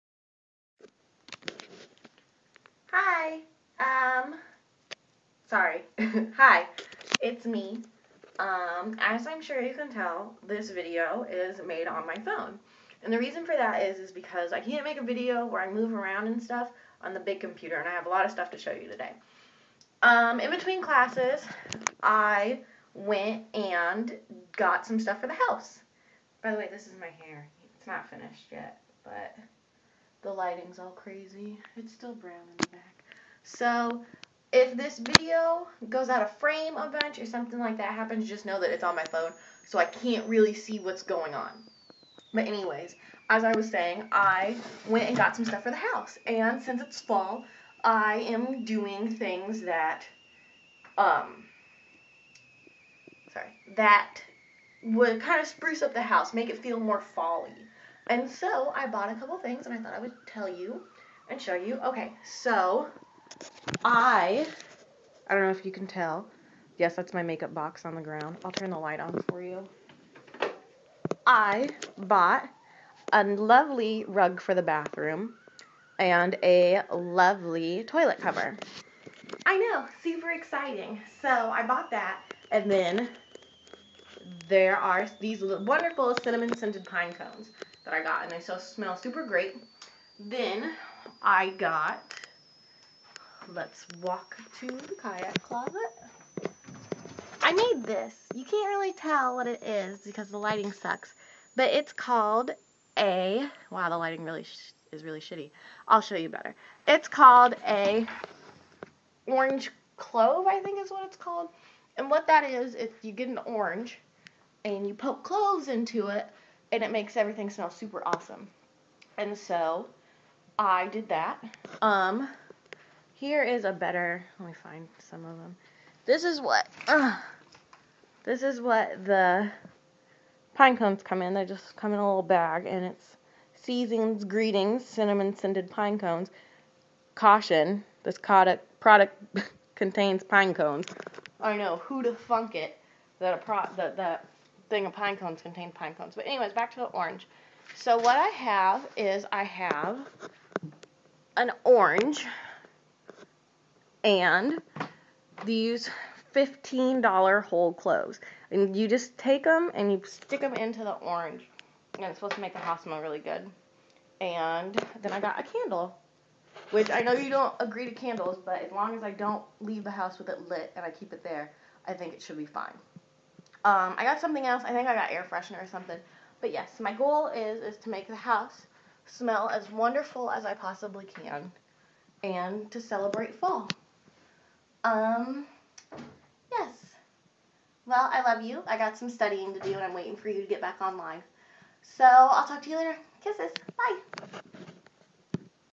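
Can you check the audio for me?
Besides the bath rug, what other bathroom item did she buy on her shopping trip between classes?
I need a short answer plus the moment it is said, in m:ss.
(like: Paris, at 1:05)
Toilet cover, at 1:17.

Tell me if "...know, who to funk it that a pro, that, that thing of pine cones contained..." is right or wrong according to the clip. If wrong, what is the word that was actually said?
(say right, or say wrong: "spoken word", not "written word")
right.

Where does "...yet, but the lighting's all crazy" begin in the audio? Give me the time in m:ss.
0:28.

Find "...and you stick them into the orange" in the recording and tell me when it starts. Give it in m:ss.
2:39.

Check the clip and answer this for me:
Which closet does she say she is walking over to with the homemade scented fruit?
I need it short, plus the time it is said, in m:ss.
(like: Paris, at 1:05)
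Kayak closet, at 1:34.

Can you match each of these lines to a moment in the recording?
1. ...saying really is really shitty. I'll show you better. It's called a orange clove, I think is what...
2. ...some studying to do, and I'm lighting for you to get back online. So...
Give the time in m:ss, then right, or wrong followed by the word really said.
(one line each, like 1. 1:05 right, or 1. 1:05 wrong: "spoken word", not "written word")
1. 1:43 wrong: "lighting", not "saying"
2. 3:08 wrong: "waiting", not "lighting".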